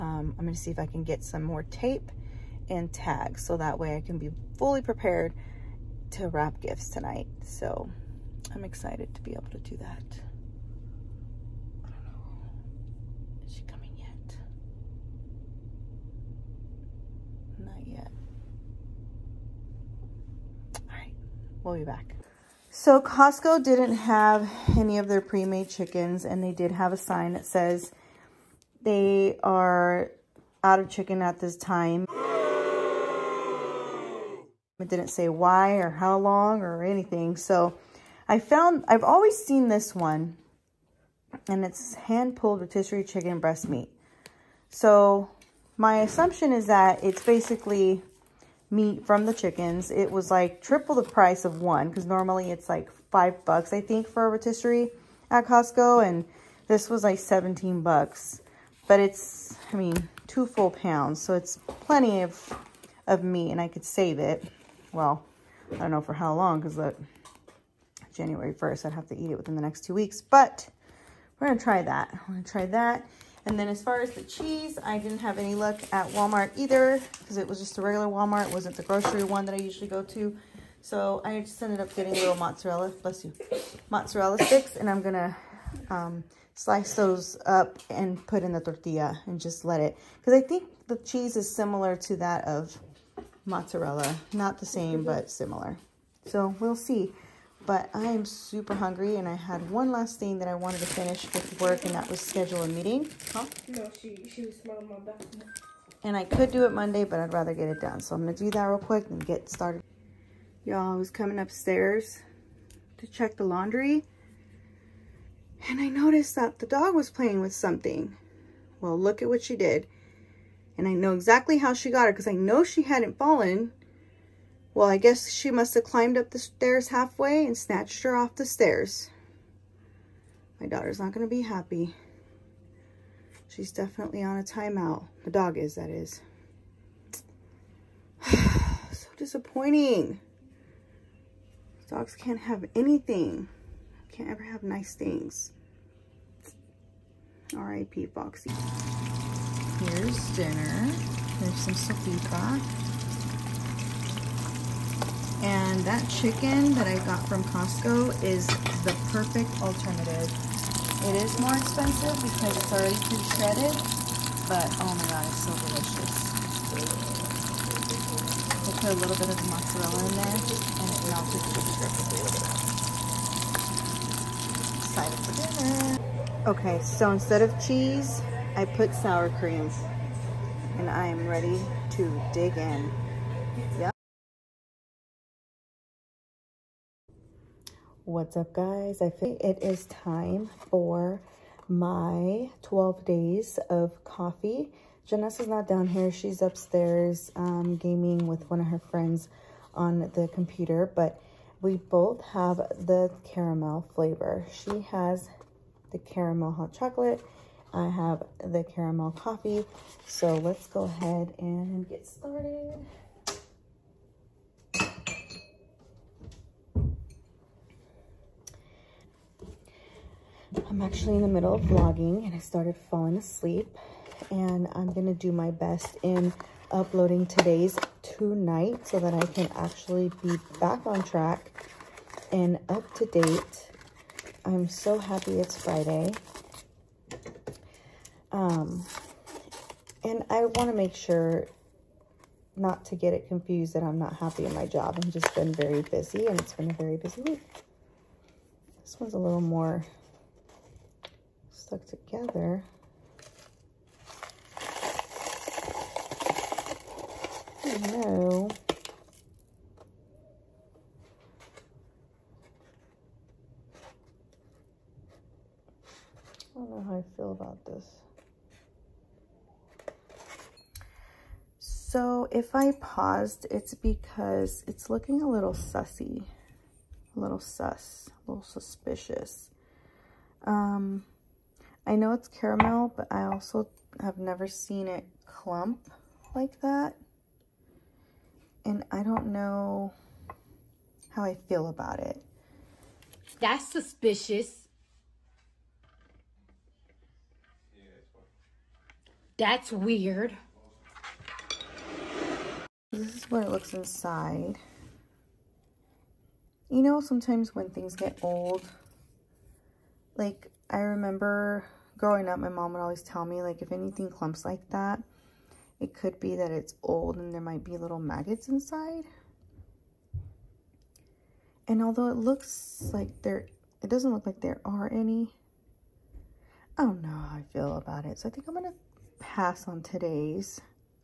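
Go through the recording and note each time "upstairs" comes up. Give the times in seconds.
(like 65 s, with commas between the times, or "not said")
111 s, 196 s.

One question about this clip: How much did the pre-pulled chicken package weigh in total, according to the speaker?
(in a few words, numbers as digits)
2 pounds.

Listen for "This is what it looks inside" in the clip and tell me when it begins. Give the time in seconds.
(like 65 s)
302 s.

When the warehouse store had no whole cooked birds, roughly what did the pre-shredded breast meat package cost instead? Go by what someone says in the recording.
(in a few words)
$17.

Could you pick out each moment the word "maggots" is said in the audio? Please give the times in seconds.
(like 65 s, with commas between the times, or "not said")
317 s.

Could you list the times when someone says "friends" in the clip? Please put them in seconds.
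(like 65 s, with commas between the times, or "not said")
198 s.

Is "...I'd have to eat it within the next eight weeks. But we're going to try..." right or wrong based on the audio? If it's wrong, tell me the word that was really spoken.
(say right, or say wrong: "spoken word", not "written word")
wrong: "two", not "eight".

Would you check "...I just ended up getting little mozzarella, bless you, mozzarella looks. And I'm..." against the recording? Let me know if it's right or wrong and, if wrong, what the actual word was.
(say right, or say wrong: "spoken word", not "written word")
wrong: "sticks", not "looks".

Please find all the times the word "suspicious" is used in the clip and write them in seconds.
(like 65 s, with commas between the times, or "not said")
278 s, 293 s.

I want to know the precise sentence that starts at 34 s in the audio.
It didn't say why or how long or anything.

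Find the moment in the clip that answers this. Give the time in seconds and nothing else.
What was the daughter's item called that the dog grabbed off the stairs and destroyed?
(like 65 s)
148 s.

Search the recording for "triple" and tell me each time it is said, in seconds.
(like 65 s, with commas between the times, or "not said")
50 s.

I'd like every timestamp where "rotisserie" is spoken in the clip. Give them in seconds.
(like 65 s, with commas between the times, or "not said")
42 s, 54 s.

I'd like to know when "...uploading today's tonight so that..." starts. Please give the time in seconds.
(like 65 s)
226 s.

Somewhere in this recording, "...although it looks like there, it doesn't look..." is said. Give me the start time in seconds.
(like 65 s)
321 s.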